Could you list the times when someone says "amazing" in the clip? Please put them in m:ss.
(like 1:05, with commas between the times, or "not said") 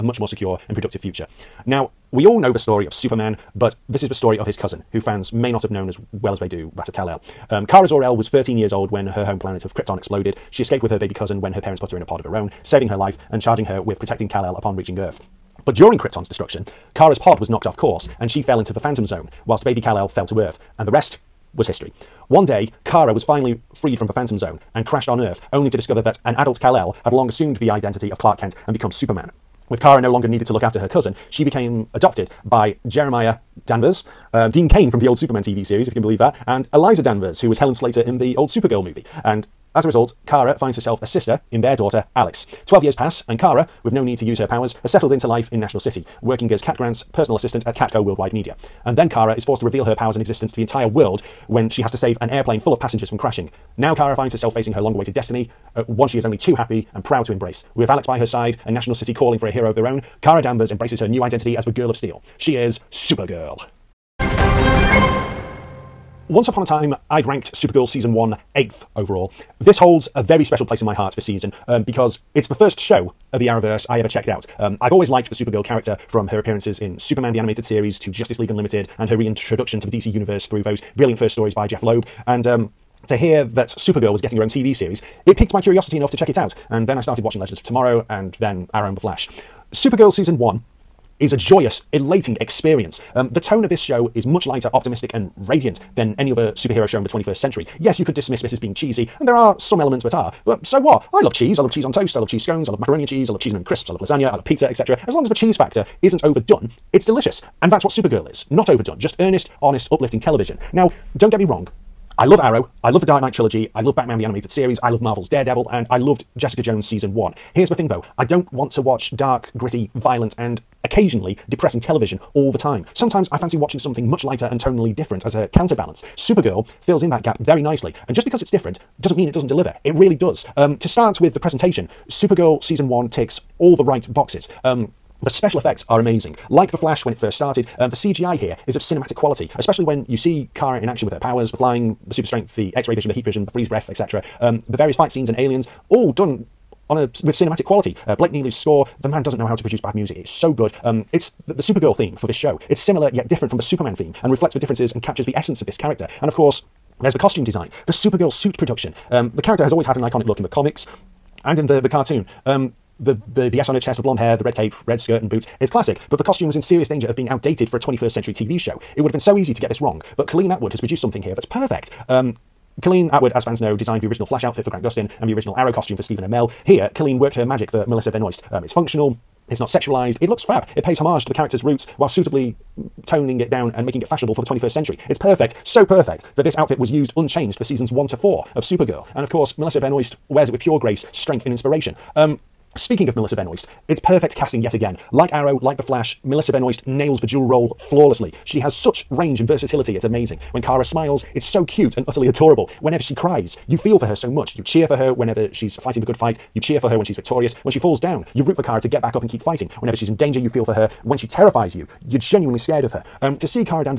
2:15, 3:20.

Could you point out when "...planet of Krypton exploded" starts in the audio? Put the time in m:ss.
0:09.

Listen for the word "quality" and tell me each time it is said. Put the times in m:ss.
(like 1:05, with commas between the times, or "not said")
2:19, 2:27.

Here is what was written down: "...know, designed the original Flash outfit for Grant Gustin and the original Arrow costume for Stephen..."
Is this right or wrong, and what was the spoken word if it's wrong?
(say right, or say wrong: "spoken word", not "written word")
right.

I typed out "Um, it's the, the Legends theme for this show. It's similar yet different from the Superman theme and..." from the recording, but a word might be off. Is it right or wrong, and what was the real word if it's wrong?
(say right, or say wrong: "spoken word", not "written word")
wrong: "Supergirl", not "Legends".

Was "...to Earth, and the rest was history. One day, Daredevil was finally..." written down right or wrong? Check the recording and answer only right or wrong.
wrong.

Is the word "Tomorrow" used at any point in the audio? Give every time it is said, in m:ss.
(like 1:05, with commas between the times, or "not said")
1:27.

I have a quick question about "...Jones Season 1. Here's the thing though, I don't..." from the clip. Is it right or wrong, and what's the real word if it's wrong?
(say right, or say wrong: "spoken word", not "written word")
right.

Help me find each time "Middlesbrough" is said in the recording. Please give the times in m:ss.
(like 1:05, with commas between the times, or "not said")
not said.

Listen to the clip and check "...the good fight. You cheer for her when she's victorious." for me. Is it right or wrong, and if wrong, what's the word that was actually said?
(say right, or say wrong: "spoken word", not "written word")
right.